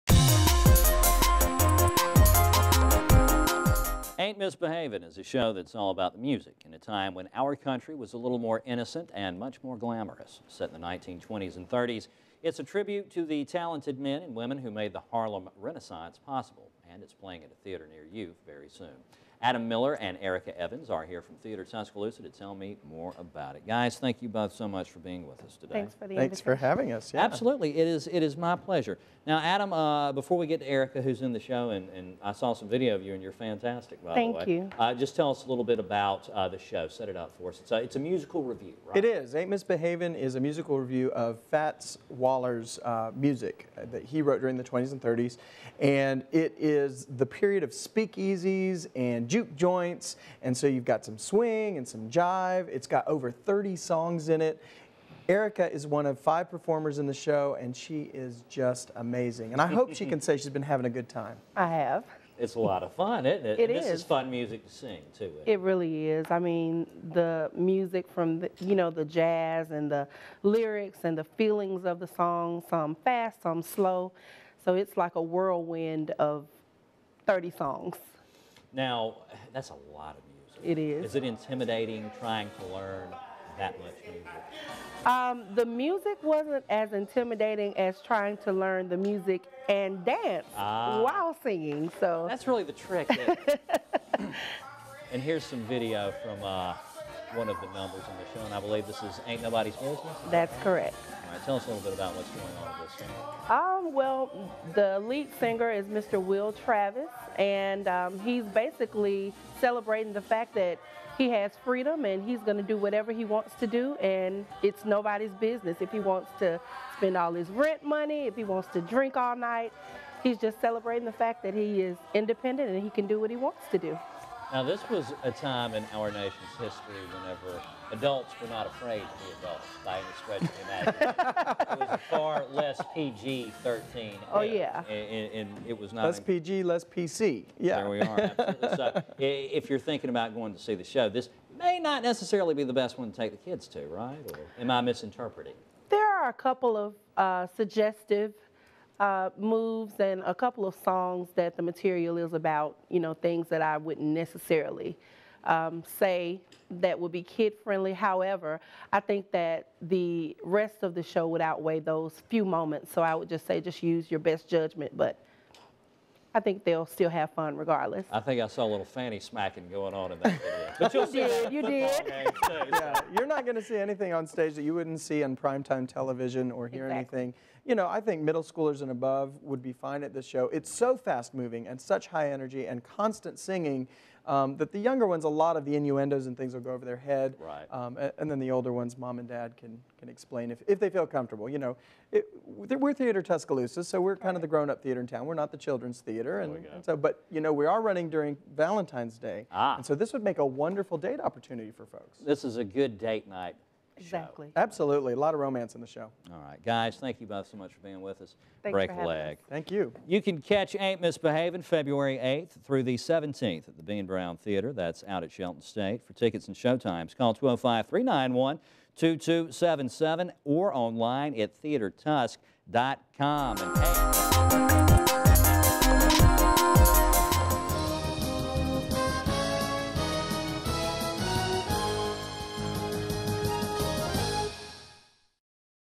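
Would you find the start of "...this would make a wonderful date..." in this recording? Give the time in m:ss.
3:19.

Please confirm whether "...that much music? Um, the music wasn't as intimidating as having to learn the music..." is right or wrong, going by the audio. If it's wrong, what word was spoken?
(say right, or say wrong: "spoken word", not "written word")
wrong: "trying", not "having".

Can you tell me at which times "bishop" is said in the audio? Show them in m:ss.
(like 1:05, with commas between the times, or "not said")
not said.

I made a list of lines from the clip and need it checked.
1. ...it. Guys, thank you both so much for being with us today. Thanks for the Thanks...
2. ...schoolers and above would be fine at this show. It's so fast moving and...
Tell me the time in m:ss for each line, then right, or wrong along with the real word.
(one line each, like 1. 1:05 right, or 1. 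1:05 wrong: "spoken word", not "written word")
1. 0:23 right
2. 2:58 right.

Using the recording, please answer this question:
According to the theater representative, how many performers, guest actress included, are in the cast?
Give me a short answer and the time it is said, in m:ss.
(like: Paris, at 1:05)
5, at 0:56.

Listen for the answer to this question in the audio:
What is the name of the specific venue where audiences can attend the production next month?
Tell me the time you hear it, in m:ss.
3:33.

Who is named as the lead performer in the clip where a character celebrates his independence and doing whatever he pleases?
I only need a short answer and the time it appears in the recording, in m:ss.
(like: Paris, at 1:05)
Will Travis, at 1:46.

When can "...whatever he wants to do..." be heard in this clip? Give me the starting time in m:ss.
1:52.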